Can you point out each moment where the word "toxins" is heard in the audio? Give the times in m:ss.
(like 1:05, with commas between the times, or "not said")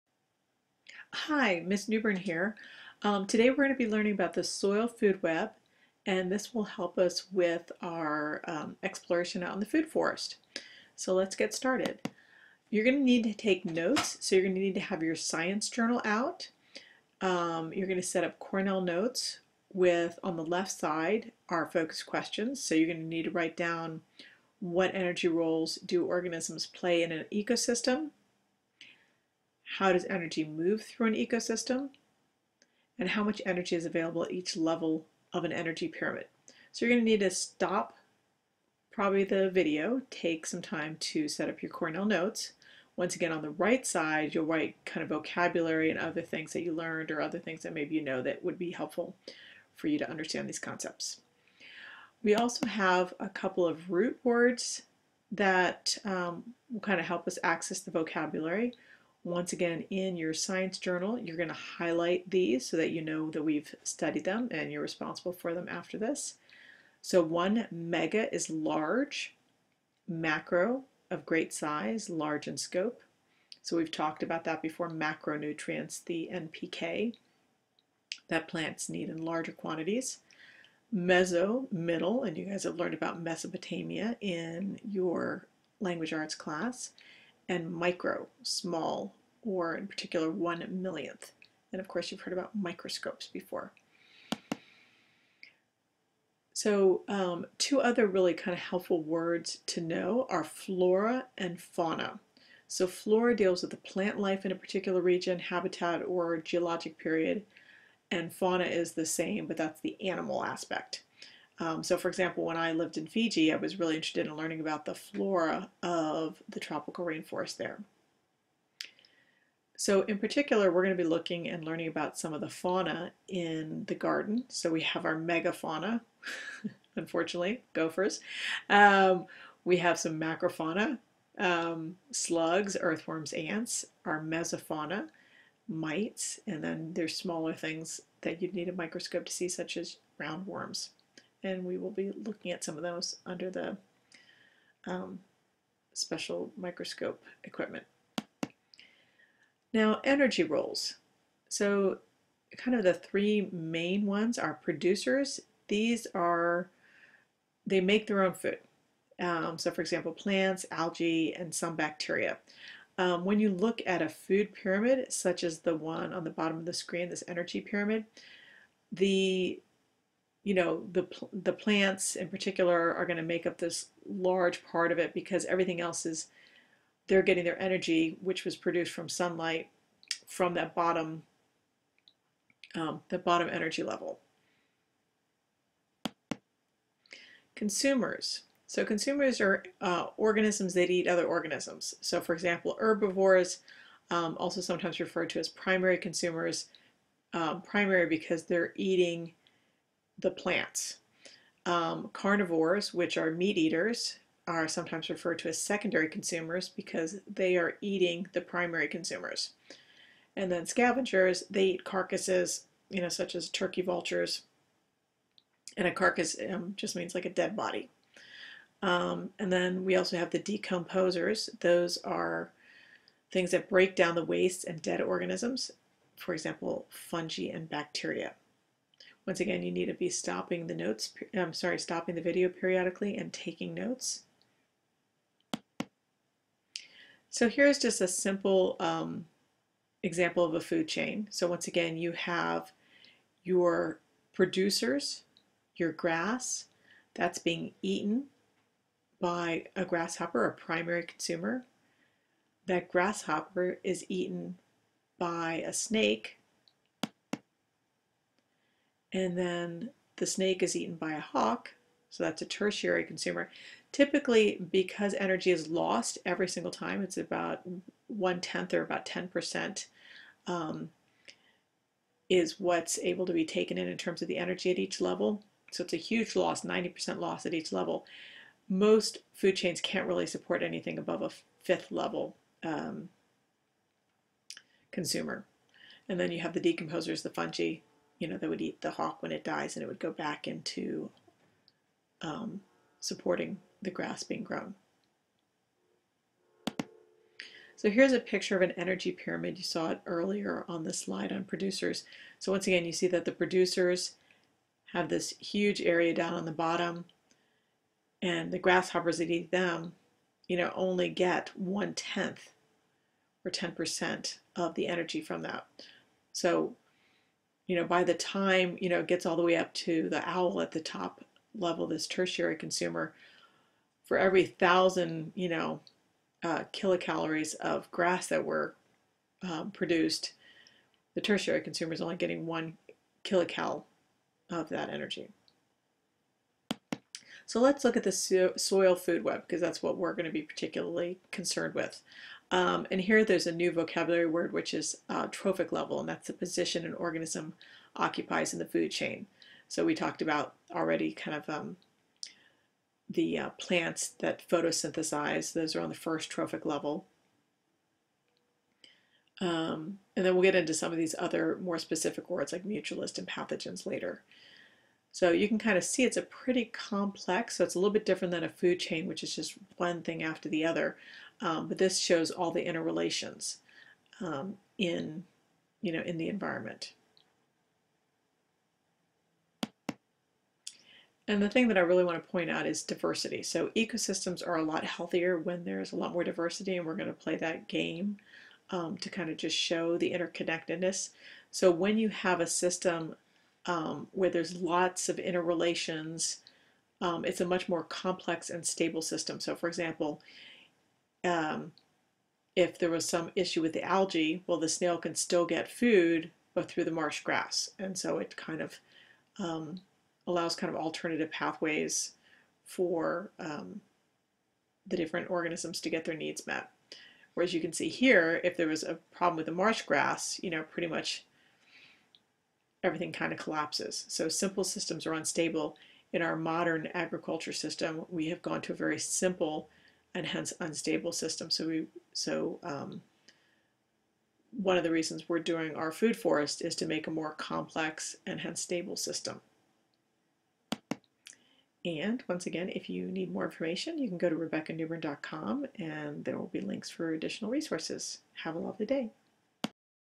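not said.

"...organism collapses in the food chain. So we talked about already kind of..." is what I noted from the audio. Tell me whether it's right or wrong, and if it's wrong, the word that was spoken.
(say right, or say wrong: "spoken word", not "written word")
wrong: "occupies", not "collapses".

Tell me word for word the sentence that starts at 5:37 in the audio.
So let's look at the so soil food web because that's what we're going to be particularly concerned with.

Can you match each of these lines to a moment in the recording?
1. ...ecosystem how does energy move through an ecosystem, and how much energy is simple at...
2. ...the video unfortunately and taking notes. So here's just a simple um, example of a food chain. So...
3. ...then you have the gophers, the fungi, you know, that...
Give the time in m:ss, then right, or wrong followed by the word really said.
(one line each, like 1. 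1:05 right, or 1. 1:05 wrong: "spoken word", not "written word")
1. 0:27 wrong: "available", not "simple"
2. 3:52 wrong: "periodically", not "unfortunately"
3. 4:46 wrong: "decomposers", not "gophers".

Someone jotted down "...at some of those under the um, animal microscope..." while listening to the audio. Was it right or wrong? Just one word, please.
wrong.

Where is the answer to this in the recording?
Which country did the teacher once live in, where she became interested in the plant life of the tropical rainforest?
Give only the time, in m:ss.
1:53.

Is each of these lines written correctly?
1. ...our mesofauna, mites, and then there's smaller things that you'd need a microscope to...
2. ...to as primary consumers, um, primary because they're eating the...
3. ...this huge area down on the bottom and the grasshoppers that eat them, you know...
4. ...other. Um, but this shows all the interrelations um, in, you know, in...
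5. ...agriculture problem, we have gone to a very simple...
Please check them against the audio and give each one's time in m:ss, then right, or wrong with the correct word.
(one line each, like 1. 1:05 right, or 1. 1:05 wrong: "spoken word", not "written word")
1. 2:14 right
2. 3:15 right
3. 5:05 right
4. 6:10 right
5. 7:06 wrong: "system", not "problem".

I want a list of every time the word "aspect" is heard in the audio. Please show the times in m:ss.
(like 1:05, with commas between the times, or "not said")
1:50.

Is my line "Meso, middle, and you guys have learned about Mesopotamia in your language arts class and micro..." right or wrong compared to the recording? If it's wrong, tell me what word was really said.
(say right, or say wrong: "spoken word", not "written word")
right.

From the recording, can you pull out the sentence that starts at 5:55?
Those are on the first trophic level.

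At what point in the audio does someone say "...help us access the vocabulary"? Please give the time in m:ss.
0:57.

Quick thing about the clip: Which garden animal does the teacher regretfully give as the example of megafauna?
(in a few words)
Gophers.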